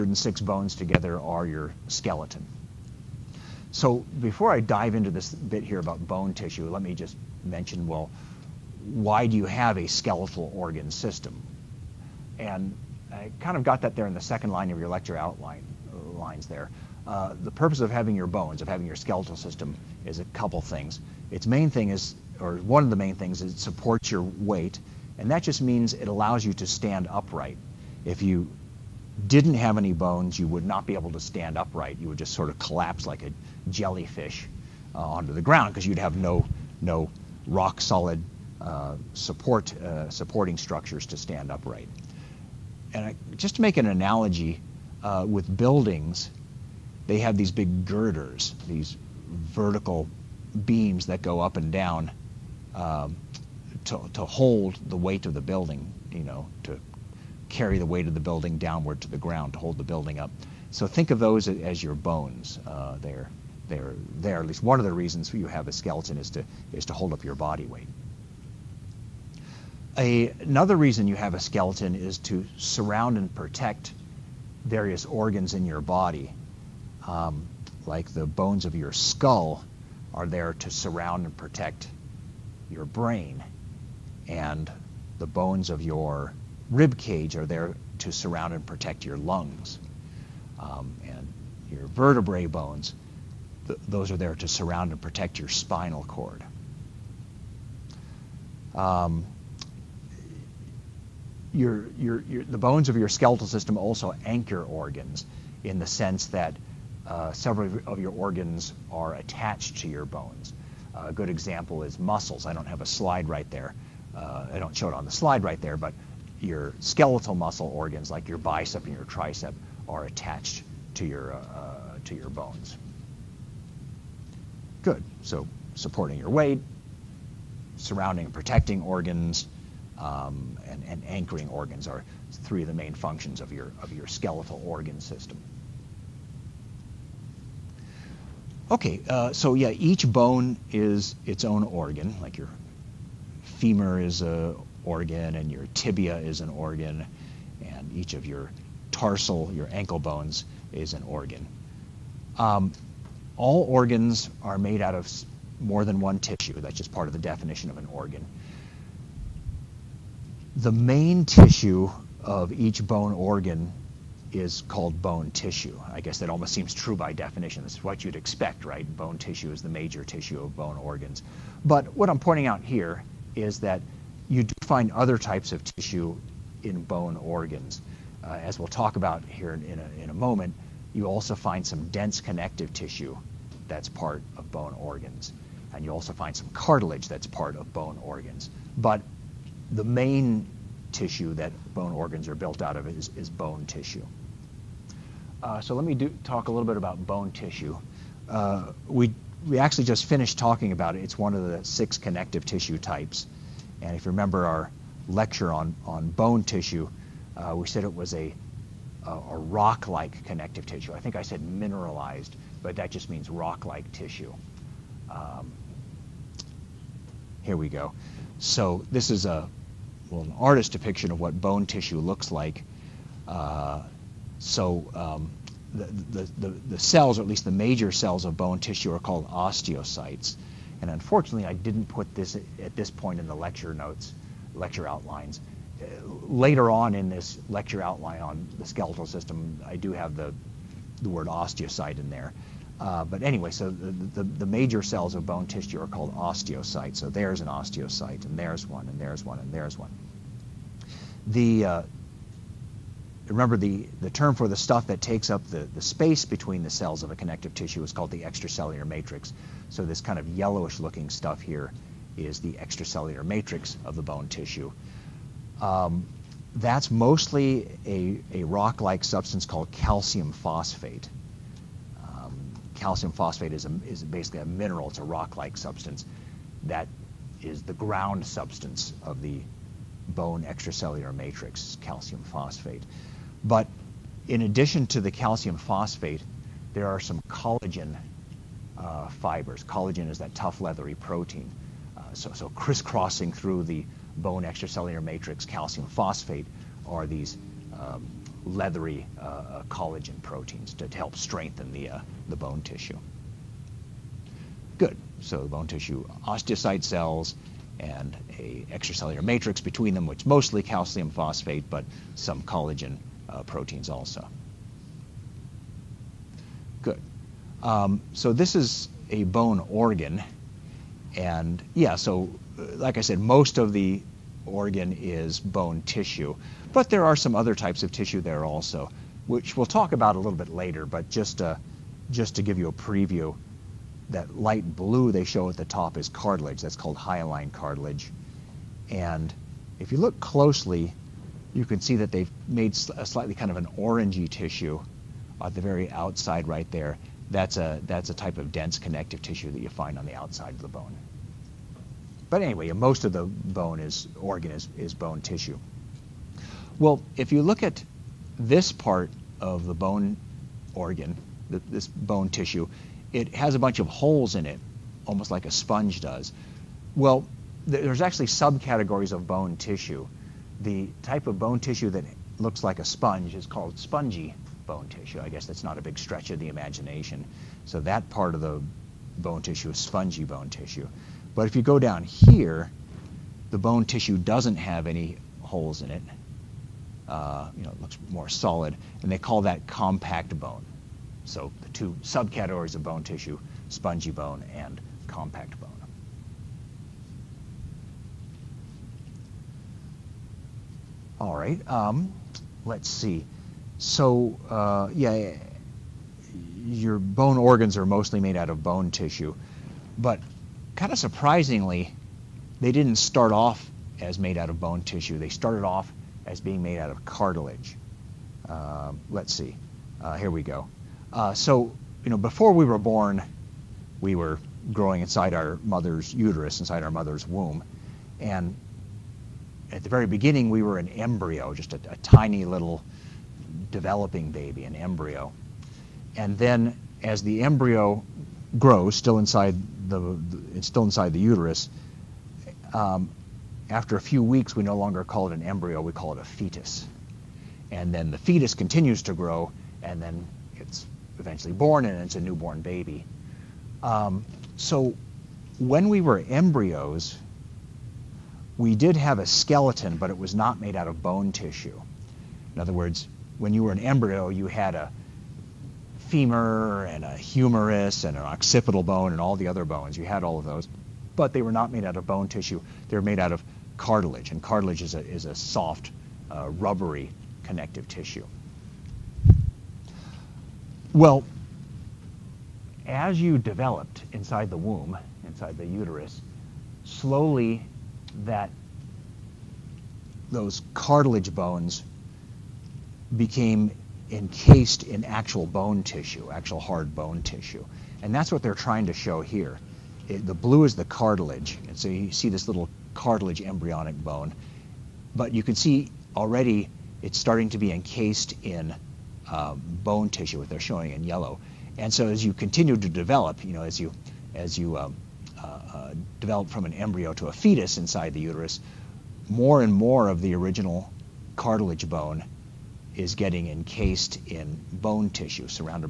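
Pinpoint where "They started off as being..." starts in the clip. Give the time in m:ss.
6:55.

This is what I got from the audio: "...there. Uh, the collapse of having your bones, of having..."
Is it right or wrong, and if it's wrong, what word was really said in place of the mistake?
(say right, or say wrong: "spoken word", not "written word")
wrong: "purpose", not "collapse".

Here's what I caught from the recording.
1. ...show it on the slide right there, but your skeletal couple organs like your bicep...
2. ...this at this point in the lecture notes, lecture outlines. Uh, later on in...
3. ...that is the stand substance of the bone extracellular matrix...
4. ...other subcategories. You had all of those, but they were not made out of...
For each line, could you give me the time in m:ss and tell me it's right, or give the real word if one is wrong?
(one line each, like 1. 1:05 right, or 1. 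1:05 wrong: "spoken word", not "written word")
1. 1:54 wrong: "muscle", not "couple"
2. 3:52 right
3. 4:36 wrong: "ground", not "stand"
4. 7:49 wrong: "bones", not "subcategories".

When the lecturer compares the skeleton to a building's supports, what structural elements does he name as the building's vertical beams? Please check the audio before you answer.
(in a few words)
girders.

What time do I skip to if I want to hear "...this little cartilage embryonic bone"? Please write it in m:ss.
8:22.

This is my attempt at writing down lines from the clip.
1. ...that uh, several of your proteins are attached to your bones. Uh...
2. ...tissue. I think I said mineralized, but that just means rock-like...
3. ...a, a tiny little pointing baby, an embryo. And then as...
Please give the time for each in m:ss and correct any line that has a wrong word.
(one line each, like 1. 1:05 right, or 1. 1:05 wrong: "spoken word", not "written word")
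1. 1:46 wrong: "organs", not "proteins"
2. 3:30 right
3. 7:11 wrong: "developing", not "pointing".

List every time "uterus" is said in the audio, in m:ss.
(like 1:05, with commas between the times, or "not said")
7:06, 7:21, 8:05, 8:38.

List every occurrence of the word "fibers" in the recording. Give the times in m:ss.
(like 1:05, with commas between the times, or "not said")
4:49.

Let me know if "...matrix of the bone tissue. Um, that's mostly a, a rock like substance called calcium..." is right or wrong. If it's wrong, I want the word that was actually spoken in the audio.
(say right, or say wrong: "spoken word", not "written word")
right.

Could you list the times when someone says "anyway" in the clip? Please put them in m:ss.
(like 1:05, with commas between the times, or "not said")
4:03, 5:52.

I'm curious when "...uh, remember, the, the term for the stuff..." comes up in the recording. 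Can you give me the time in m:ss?
4:11.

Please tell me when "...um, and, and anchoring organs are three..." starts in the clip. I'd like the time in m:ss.
2:10.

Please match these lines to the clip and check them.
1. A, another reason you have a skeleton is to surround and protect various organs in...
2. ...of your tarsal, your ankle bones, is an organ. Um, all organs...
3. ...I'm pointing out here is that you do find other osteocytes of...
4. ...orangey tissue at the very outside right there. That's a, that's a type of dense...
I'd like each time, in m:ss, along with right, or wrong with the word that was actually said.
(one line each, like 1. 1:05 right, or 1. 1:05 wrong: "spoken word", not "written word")
1. 1:09 right
2. 2:28 right
3. 2:52 wrong: "types", not "osteocytes"
4. 5:43 right.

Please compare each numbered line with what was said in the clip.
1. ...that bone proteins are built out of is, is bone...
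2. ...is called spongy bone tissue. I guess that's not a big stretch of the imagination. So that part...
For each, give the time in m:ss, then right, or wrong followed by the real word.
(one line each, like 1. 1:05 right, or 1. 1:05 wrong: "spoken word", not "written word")
1. 3:11 wrong: "organs", not "proteins"
2. 6:13 right.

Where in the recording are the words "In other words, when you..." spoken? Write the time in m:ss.
7:42.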